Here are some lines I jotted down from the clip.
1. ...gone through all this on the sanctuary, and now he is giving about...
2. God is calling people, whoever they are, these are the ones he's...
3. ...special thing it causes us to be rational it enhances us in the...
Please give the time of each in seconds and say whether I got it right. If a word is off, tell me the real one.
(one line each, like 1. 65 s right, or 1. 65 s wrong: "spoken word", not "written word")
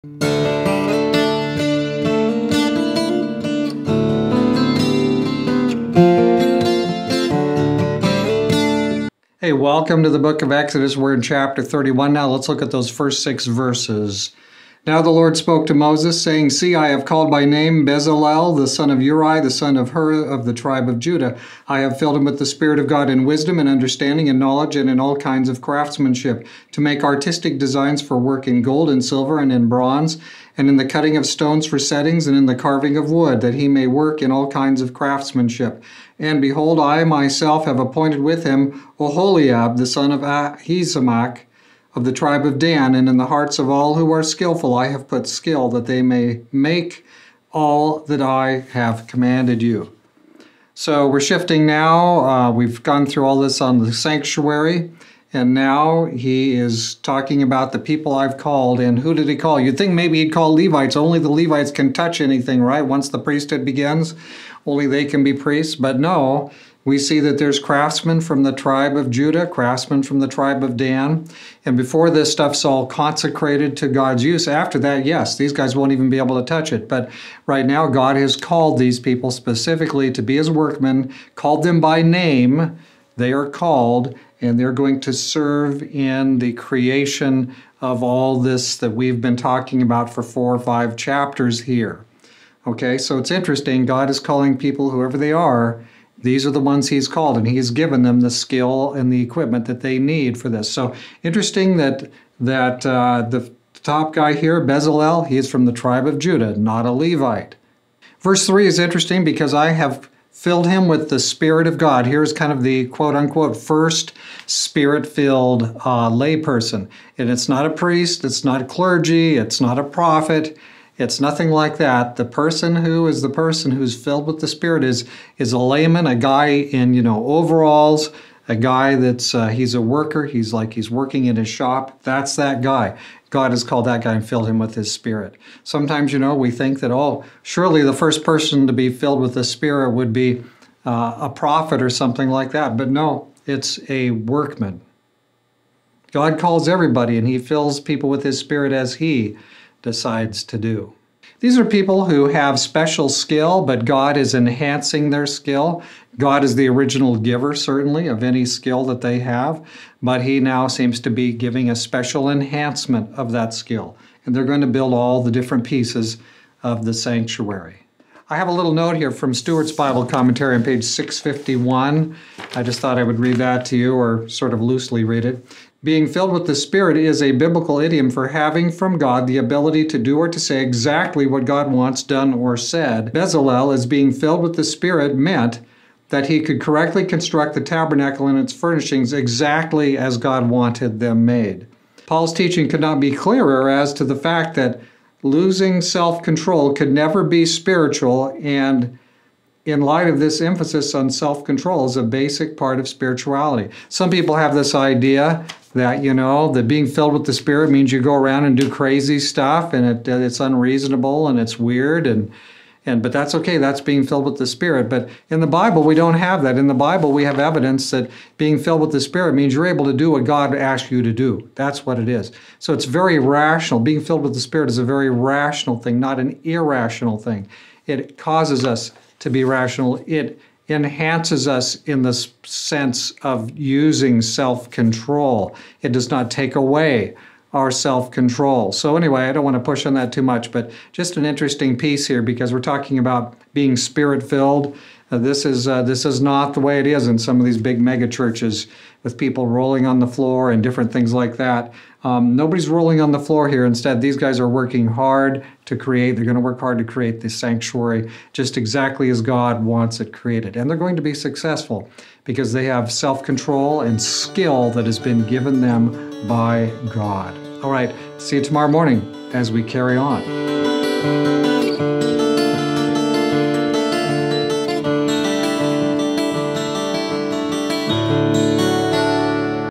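1. 52 s wrong: "talking", not "giving"
2. 93 s right
3. 226 s wrong: "irrational", not "special".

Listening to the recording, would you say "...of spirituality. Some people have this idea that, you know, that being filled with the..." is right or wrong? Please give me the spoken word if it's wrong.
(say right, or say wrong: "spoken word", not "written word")
right.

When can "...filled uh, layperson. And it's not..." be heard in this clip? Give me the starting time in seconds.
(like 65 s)
115 s.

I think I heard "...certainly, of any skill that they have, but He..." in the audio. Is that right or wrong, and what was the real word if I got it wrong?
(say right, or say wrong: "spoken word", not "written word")
right.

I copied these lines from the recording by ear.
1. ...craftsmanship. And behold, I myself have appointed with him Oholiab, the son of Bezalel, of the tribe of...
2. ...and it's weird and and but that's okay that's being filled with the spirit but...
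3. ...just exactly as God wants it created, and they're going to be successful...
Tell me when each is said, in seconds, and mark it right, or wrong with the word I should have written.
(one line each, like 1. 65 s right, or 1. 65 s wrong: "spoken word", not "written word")
1. 34 s wrong: "Ahisamach", not "Bezalel"
2. 211 s right
3. 258 s right.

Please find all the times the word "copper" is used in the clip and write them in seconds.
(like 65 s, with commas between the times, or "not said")
not said.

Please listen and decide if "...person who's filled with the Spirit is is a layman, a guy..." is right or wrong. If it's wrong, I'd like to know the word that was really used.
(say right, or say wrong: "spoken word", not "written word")
right.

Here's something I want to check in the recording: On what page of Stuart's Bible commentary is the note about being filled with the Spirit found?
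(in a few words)
651.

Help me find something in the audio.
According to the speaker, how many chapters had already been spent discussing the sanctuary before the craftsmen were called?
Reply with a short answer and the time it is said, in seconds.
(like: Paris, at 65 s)
four or five, at 90 s.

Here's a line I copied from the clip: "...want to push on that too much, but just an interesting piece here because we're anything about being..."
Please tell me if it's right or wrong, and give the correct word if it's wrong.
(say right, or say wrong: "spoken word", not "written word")
wrong: "talking", not "anything".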